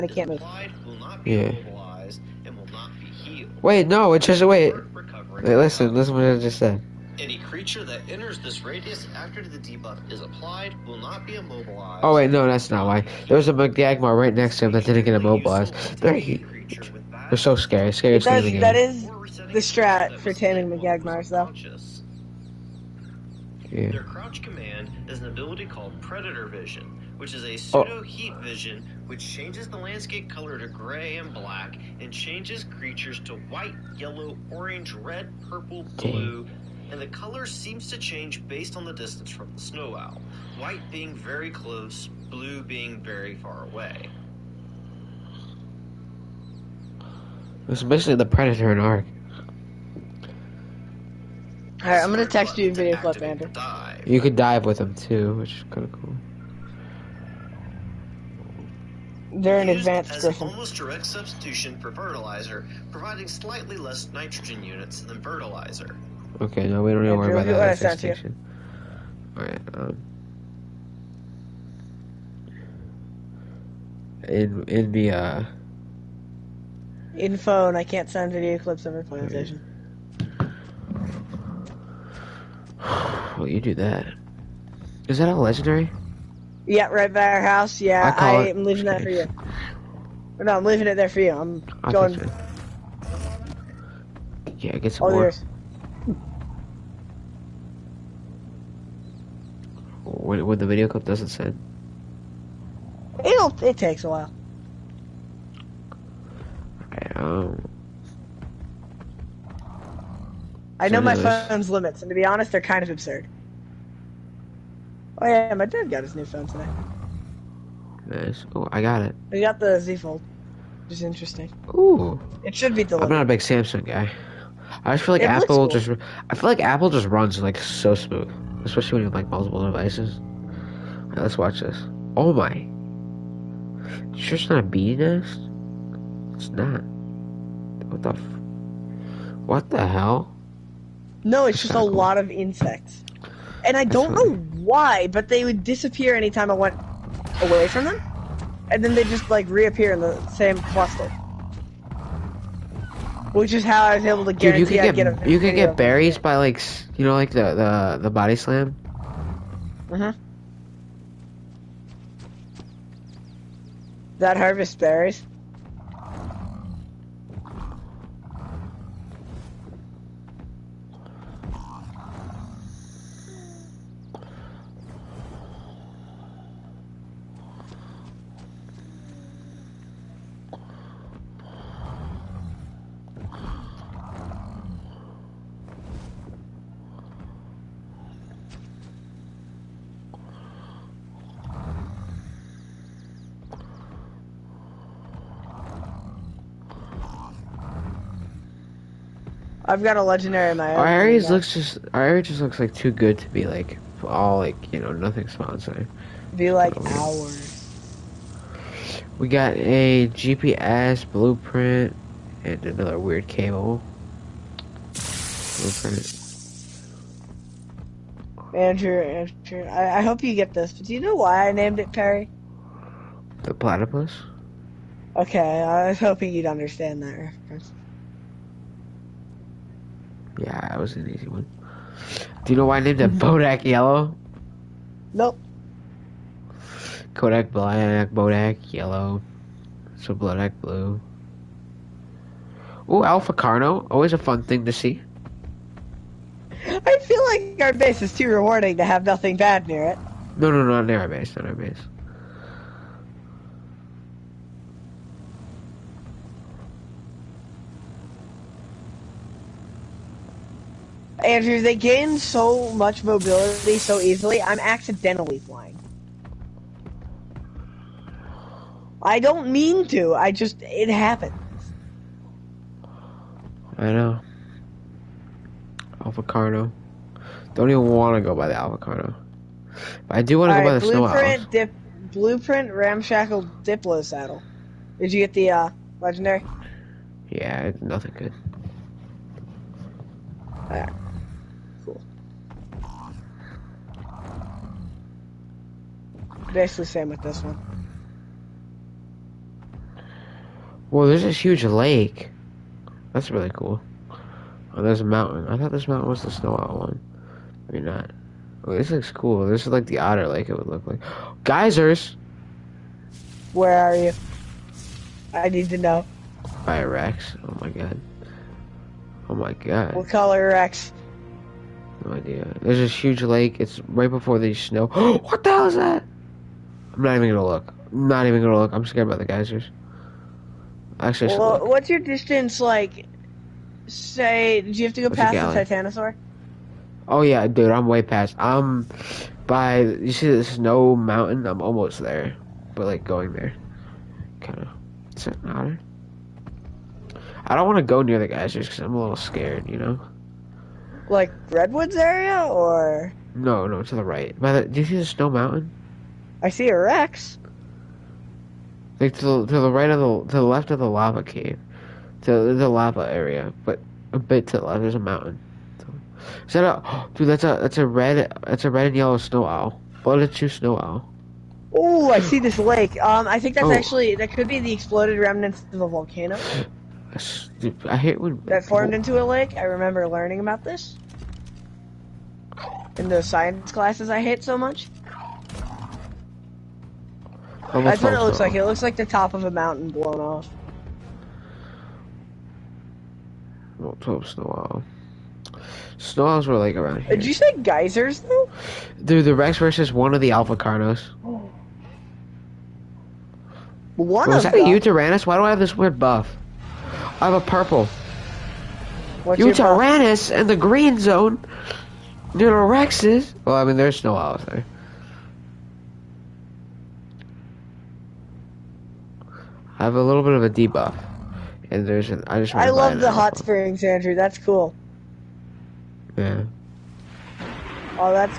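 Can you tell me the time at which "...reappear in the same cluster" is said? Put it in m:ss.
2:29.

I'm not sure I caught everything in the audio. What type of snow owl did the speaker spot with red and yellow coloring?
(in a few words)
Blooded snow owl.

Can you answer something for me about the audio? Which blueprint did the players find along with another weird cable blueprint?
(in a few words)
GPS blueprint.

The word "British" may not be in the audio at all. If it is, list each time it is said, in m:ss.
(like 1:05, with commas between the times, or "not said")
not said.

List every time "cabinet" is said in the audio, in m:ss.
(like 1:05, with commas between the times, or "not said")
not said.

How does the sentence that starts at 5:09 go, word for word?
This is like the otter lake it would look like.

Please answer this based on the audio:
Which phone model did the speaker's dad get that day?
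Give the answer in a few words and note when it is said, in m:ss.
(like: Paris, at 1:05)
Z Fold, at 1:59.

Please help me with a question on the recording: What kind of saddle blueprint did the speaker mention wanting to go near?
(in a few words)
ramshackle diplo saddle.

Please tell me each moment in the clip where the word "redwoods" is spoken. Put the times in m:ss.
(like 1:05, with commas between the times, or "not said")
5:51.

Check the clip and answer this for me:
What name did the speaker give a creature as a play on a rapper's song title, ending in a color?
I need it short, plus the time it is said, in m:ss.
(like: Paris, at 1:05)
Bodak Blue, at 4:00.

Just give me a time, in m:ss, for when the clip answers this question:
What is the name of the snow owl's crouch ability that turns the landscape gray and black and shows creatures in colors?
0:26.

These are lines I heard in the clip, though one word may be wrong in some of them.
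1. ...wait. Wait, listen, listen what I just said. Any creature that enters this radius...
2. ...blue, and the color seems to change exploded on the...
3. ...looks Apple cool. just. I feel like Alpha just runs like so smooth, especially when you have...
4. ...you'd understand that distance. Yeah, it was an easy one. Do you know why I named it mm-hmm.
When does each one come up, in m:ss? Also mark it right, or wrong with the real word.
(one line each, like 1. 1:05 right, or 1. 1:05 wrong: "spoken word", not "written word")
1. 0:04 right
2. 0:35 wrong: "based", not "exploded"
3. 2:05 wrong: "Apple", not "Alpha"
4. 3:46 wrong: "reference", not "distance".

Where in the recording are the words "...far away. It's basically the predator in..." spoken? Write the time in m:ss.
0:43.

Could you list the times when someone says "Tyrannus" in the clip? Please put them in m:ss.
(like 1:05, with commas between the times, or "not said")
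6:44, 6:49.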